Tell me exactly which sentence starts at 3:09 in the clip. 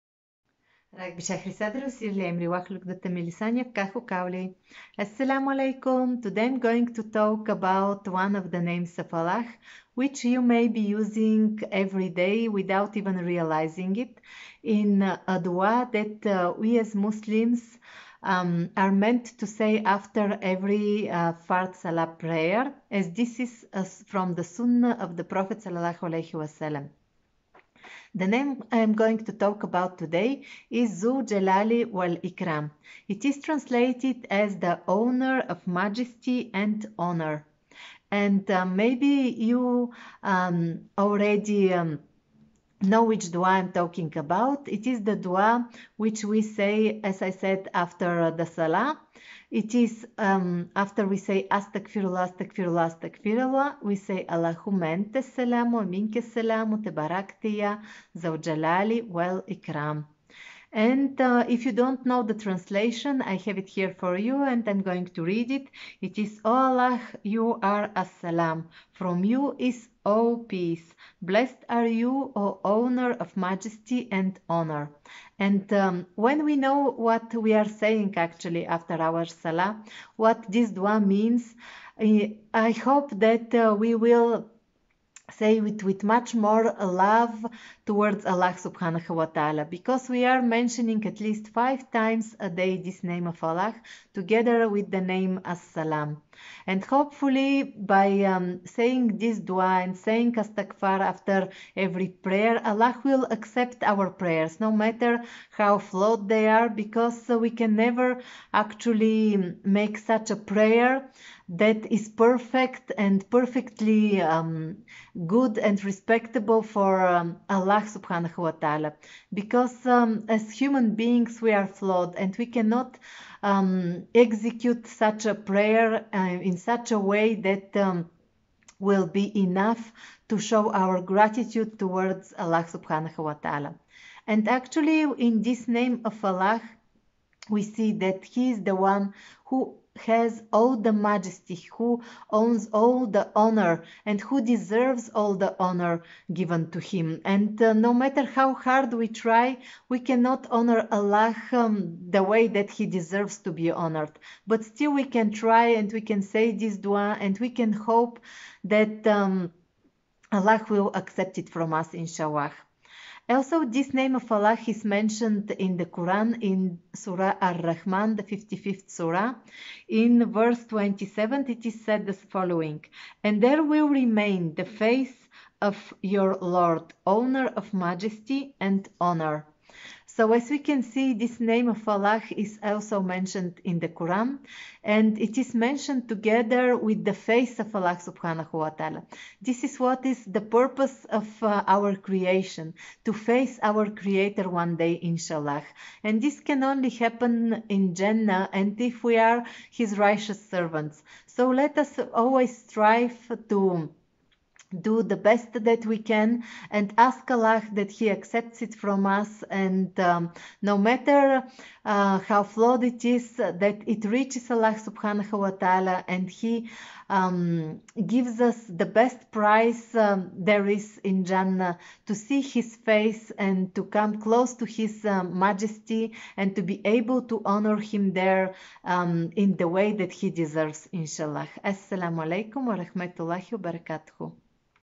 This is what is the purpose of uh, our creation, to face our Creator one day, inshallah.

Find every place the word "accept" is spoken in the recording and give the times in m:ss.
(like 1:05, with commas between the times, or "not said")
1:43, 2:40, 3:28.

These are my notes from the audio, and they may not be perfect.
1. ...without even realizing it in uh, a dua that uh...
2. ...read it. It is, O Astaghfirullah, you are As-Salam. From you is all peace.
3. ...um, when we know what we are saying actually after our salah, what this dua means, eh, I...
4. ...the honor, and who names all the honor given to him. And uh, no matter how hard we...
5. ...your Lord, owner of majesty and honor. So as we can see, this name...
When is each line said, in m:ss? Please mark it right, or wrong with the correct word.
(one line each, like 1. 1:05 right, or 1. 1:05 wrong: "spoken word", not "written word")
1. 0:12 right
2. 1:05 wrong: "Allah", not "Astaghfirullah"
3. 1:15 right
4. 2:23 wrong: "deserves", not "names"
5. 2:56 right.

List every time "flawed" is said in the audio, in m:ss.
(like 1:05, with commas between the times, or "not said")
1:45, 2:01, 3:32.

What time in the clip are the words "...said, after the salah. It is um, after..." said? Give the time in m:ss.
0:47.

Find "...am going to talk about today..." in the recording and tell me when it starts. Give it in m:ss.
0:28.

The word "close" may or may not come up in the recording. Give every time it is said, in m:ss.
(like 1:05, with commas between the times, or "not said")
3:44.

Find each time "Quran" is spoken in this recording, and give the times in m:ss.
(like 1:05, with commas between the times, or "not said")
2:45, 3:03.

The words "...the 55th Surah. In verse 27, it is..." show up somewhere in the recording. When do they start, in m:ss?
2:48.